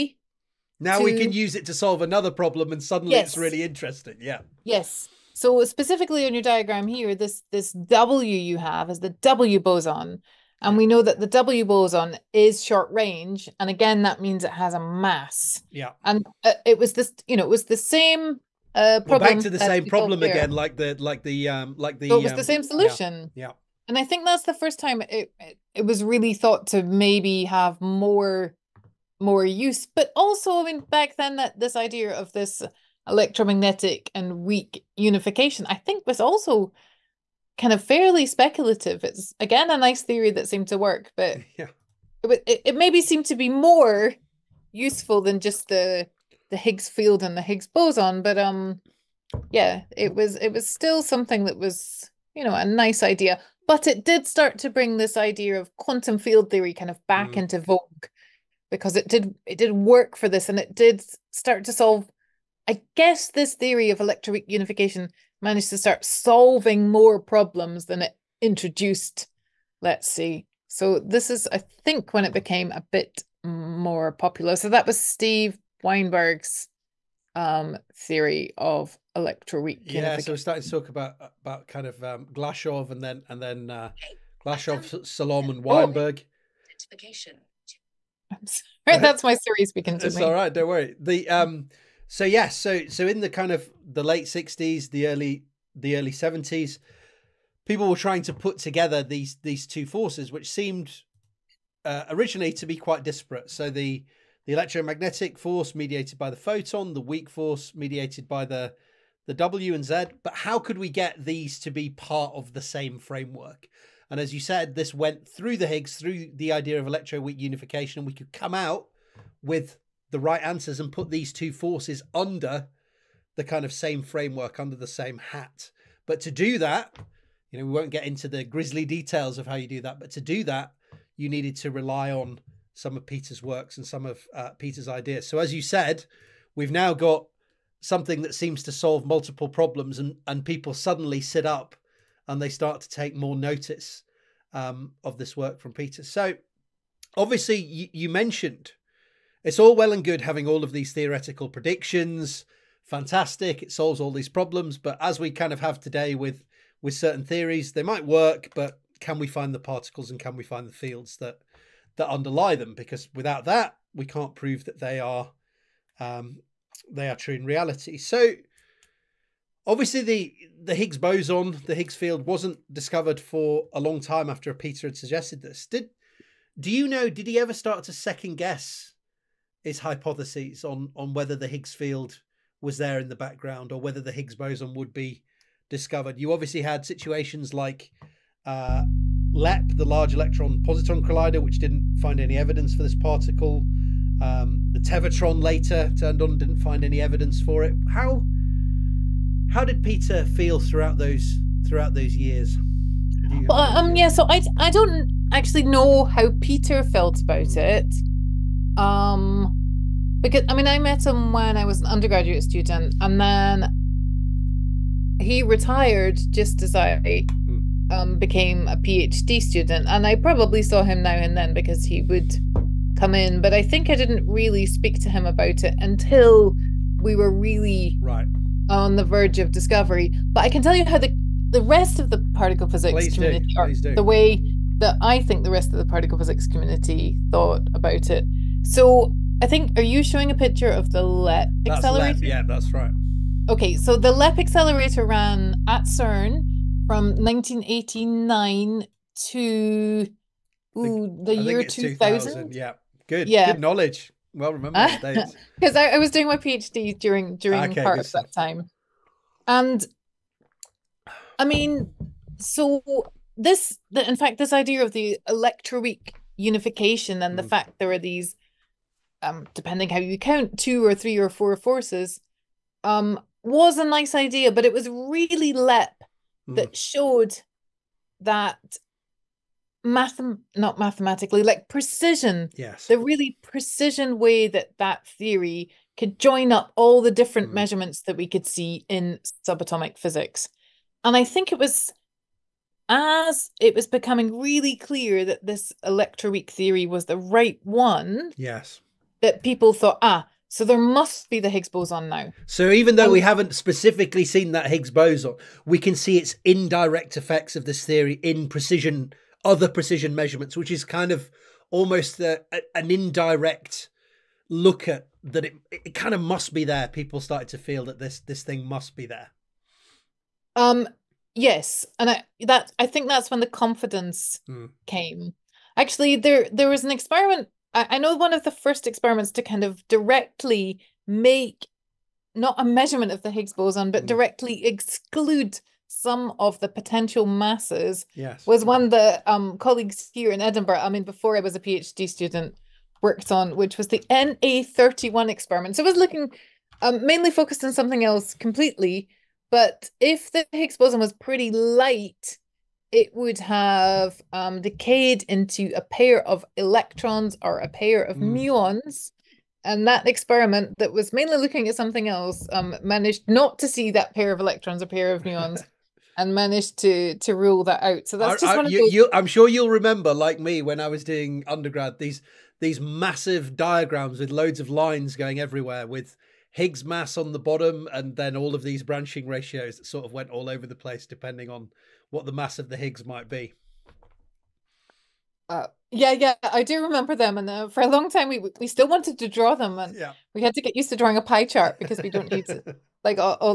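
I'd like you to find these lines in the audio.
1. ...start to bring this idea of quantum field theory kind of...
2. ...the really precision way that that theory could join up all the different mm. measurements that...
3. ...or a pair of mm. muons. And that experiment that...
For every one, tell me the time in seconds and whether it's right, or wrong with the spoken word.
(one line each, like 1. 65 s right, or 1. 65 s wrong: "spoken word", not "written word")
1. 54 s right
2. 282 s right
3. 357 s right.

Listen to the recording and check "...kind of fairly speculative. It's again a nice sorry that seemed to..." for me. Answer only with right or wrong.
wrong.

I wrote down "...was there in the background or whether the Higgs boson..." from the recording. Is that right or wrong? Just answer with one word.
right.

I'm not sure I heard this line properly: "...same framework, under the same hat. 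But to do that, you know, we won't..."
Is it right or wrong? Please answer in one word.
right.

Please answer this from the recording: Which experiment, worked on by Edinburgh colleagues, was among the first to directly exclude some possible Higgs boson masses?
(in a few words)
NA31.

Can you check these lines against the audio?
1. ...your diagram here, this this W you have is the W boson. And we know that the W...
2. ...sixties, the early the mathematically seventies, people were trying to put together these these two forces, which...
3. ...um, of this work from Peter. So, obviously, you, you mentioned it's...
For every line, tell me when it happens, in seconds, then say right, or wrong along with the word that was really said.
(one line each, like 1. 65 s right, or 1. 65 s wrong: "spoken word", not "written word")
1. 6 s right
2. 94 s wrong: "early", not "mathematically"
3. 144 s right.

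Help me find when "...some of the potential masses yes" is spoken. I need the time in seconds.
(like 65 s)
335 s.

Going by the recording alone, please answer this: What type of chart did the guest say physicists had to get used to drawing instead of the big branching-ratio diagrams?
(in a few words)
pie chart.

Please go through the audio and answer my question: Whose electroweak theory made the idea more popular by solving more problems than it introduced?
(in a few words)
Steve Weinberg.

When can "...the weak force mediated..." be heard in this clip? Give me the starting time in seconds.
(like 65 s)
106 s.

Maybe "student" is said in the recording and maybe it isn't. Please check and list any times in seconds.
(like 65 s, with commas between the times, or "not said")
212 s, 219 s, 342 s.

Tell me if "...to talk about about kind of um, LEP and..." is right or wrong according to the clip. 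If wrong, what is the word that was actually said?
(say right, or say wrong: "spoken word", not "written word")
wrong: "Glashow", not "LEP".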